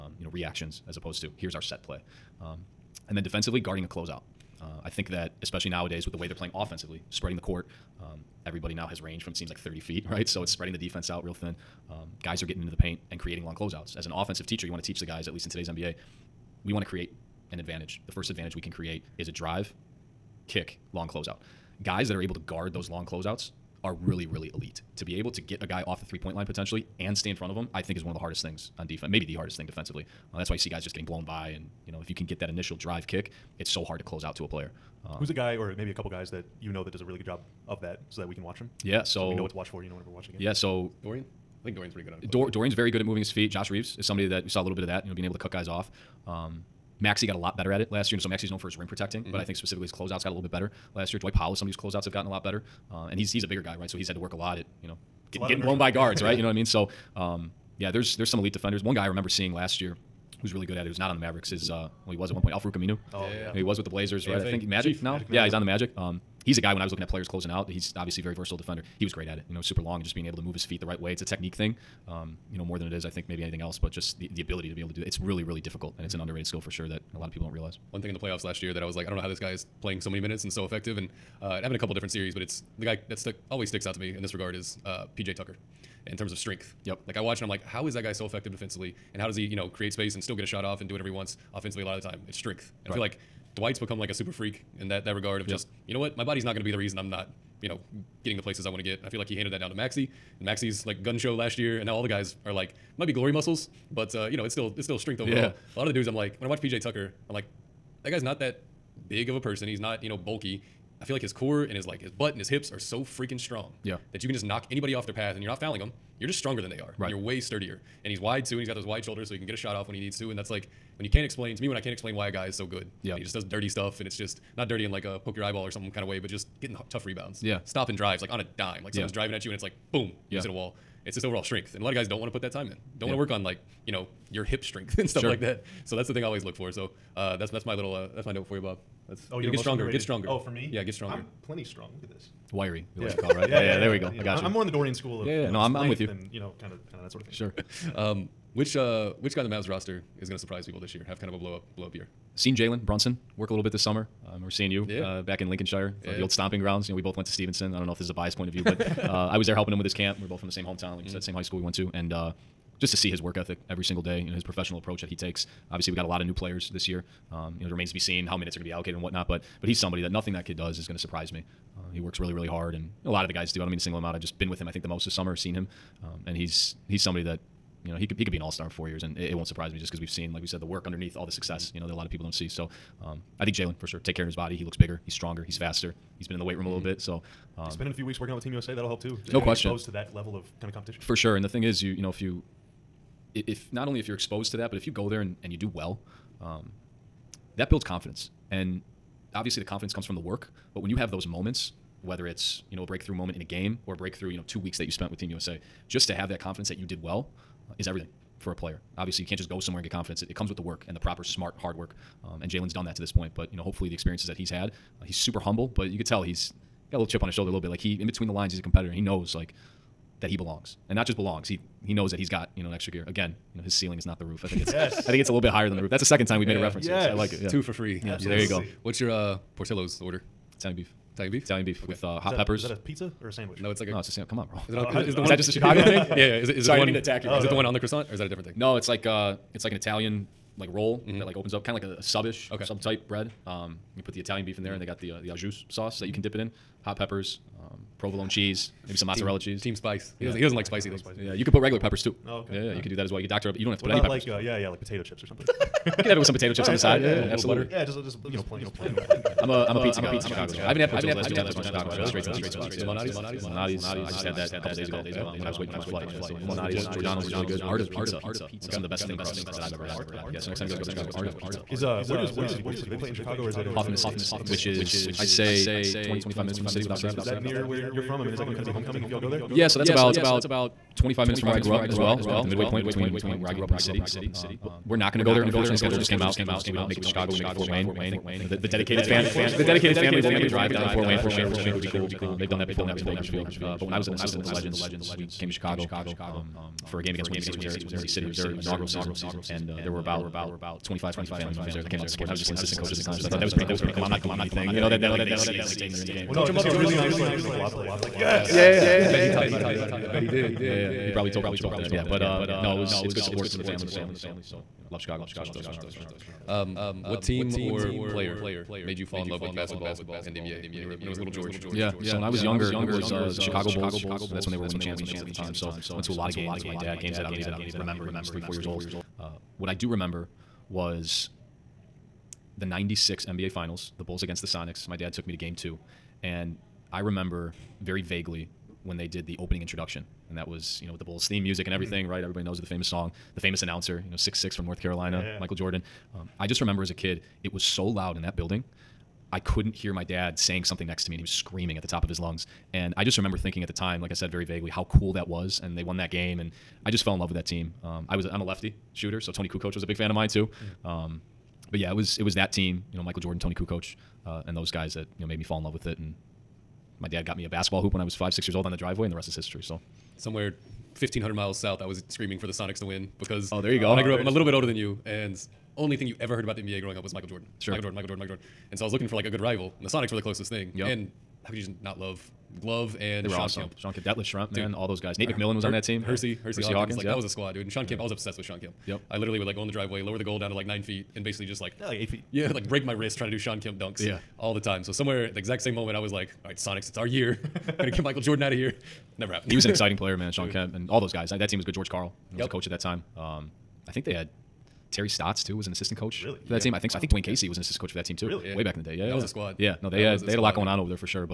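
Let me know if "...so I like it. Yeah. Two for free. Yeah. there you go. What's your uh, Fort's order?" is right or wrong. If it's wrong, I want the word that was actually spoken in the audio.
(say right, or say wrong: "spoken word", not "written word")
wrong: "Portillo", not "Fort".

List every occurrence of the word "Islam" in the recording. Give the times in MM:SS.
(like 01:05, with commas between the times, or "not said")
not said.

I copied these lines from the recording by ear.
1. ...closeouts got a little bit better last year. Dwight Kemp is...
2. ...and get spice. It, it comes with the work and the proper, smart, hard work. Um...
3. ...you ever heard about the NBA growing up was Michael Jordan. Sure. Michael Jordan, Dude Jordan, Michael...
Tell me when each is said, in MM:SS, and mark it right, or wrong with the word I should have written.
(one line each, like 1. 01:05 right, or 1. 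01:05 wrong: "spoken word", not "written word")
1. 00:49 wrong: "Powell", not "Kemp"
2. 03:29 wrong: "confidence", not "spice"
3. 06:16 wrong: "Michael", not "Dude".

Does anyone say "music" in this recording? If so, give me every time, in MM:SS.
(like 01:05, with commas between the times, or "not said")
05:41.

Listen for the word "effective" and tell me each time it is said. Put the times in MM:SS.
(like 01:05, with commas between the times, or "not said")
01:20, 01:28.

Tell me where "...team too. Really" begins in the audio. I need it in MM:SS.
06:48.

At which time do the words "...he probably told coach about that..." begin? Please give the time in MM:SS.
05:11.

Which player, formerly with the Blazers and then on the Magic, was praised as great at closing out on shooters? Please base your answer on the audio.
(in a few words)
Al-Farouq Aminu.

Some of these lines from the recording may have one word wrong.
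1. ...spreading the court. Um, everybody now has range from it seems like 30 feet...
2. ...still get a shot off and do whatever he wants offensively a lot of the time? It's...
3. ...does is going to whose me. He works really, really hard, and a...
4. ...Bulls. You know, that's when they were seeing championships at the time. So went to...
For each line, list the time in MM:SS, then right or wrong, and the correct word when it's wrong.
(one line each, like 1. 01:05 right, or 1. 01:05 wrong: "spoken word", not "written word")
1. 00:07 right
2. 01:30 right
3. 02:50 wrong: "surprise", not "whose"
4. 05:23 wrong: "winning", not "seeing".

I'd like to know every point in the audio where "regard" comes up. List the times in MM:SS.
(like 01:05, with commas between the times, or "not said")
01:24, 01:35.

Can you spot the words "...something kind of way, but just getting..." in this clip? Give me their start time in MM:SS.
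02:05.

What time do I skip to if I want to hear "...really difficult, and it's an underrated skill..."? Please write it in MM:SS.
01:15.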